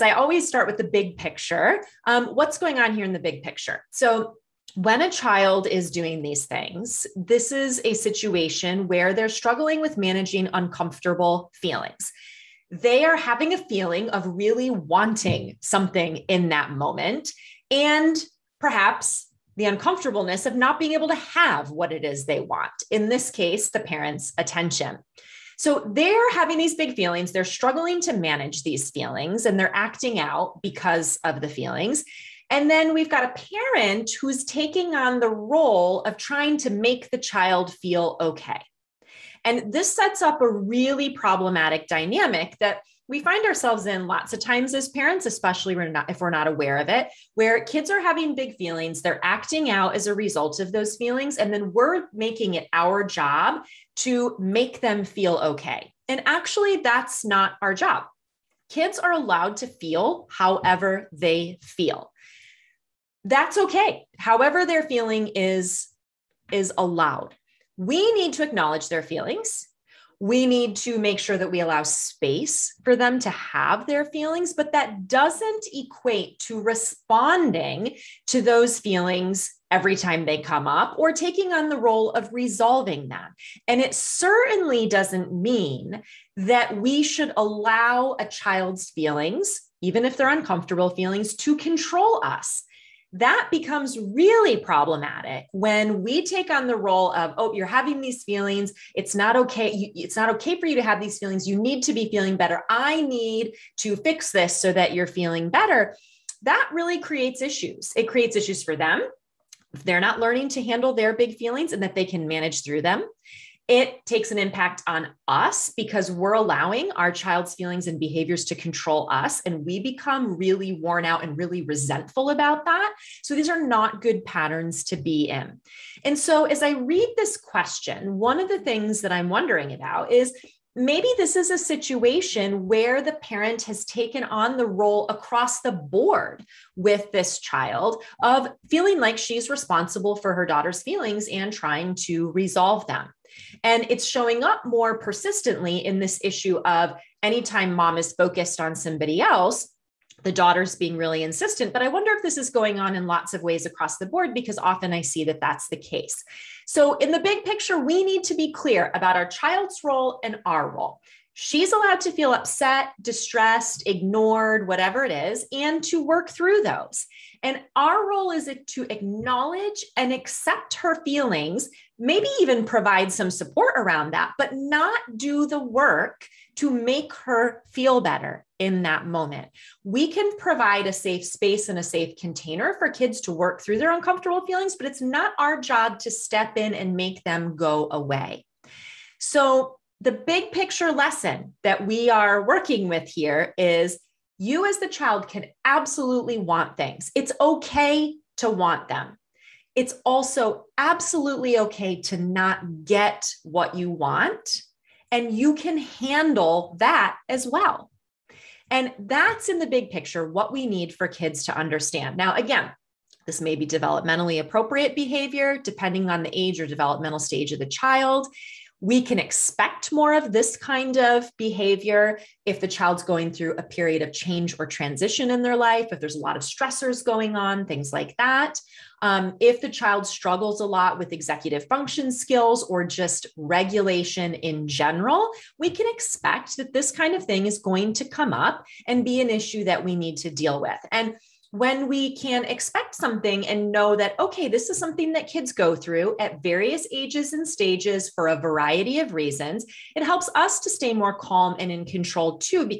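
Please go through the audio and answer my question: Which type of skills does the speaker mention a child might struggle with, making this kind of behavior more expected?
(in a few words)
executive function skills.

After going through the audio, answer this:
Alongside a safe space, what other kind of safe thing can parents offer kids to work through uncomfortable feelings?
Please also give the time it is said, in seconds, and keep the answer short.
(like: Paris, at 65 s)
safe container, at 181 s.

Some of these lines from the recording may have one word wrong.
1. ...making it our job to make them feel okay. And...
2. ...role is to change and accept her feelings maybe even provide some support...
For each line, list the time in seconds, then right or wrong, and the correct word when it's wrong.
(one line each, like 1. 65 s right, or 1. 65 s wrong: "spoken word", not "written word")
1. 52 s right
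2. 168 s wrong: "acknowledge", not "change".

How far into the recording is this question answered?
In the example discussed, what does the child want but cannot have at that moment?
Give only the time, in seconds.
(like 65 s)
23 s.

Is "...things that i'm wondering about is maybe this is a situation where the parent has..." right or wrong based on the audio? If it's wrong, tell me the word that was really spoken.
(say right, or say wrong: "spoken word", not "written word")
right.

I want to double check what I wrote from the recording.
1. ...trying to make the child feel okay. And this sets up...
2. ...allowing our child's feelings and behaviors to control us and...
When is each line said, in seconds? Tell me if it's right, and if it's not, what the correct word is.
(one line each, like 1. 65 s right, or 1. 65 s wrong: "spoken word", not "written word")
1. 36 s right
2. 116 s right.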